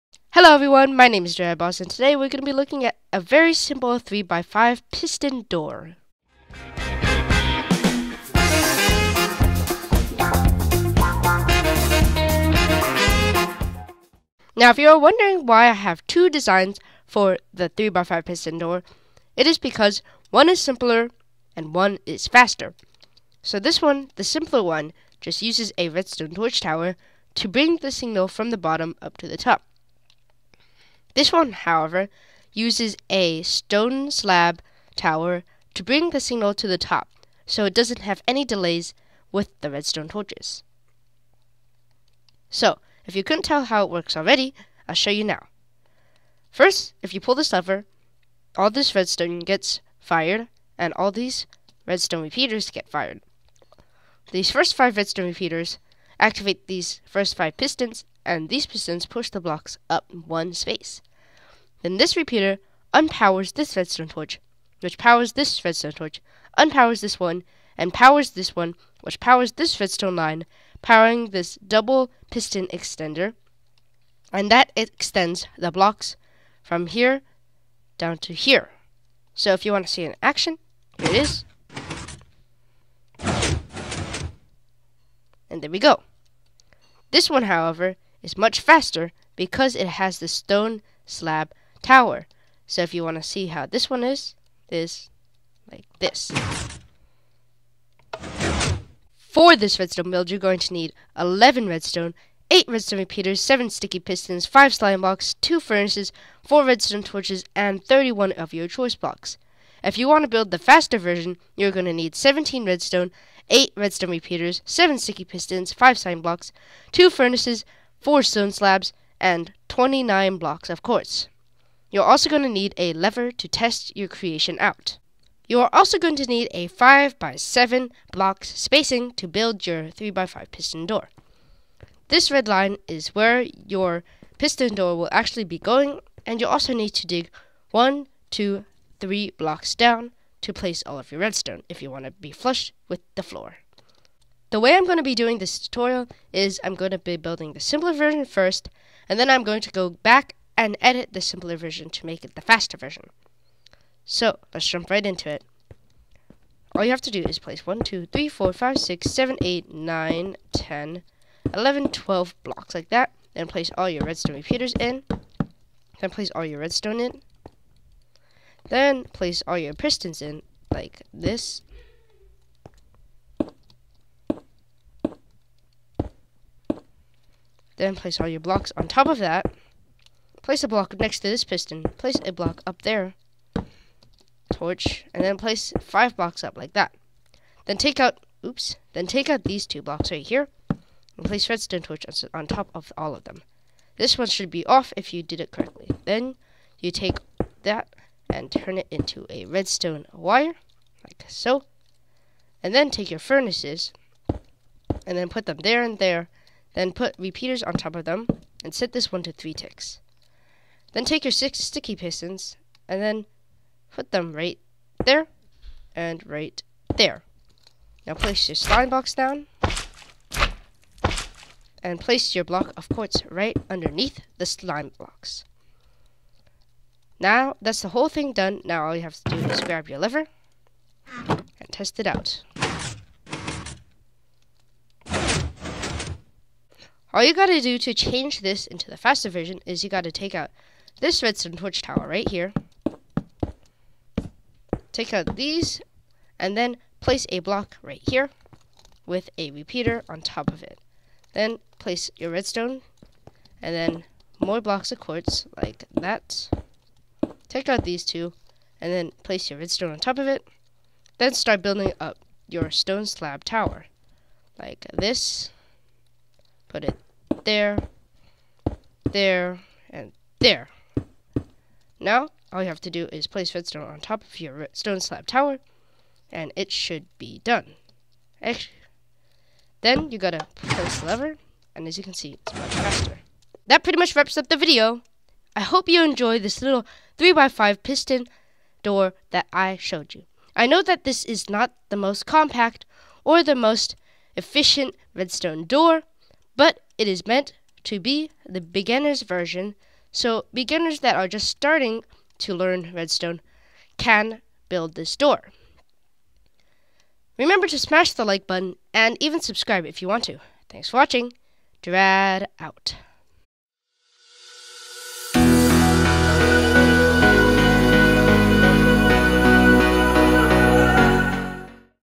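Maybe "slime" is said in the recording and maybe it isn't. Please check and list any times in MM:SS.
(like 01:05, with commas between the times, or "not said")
01:44, 01:55, 03:38, 03:44.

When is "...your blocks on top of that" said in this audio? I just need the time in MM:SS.
02:58.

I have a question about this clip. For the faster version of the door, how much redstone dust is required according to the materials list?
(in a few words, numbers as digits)
17.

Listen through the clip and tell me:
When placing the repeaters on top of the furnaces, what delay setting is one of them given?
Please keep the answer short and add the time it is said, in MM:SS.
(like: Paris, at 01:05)
3 ticks, at 03:29.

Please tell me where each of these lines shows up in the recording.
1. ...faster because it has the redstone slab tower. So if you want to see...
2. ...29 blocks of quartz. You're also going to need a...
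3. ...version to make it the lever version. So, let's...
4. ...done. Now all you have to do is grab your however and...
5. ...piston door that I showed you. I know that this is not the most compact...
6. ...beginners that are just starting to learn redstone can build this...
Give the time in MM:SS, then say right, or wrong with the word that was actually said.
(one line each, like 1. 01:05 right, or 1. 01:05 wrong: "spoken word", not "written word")
1. 01:28 wrong: "stone", not "redstone"
2. 01:59 right
3. 02:31 wrong: "faster", not "lever"
4. 03:48 wrong: "lever", not "however"
5. 04:47 right
6. 05:00 right.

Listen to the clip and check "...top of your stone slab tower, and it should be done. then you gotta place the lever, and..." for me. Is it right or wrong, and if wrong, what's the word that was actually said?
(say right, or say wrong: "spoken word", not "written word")
right.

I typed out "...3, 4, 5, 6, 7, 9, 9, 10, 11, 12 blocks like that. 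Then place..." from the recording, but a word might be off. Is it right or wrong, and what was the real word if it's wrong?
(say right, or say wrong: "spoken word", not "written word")
wrong: "8", not "9".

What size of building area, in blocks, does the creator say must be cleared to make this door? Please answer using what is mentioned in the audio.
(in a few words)
5 by 7.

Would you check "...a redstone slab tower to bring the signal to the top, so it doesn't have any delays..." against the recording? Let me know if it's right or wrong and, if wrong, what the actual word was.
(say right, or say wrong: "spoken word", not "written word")
wrong: "stone", not "redstone".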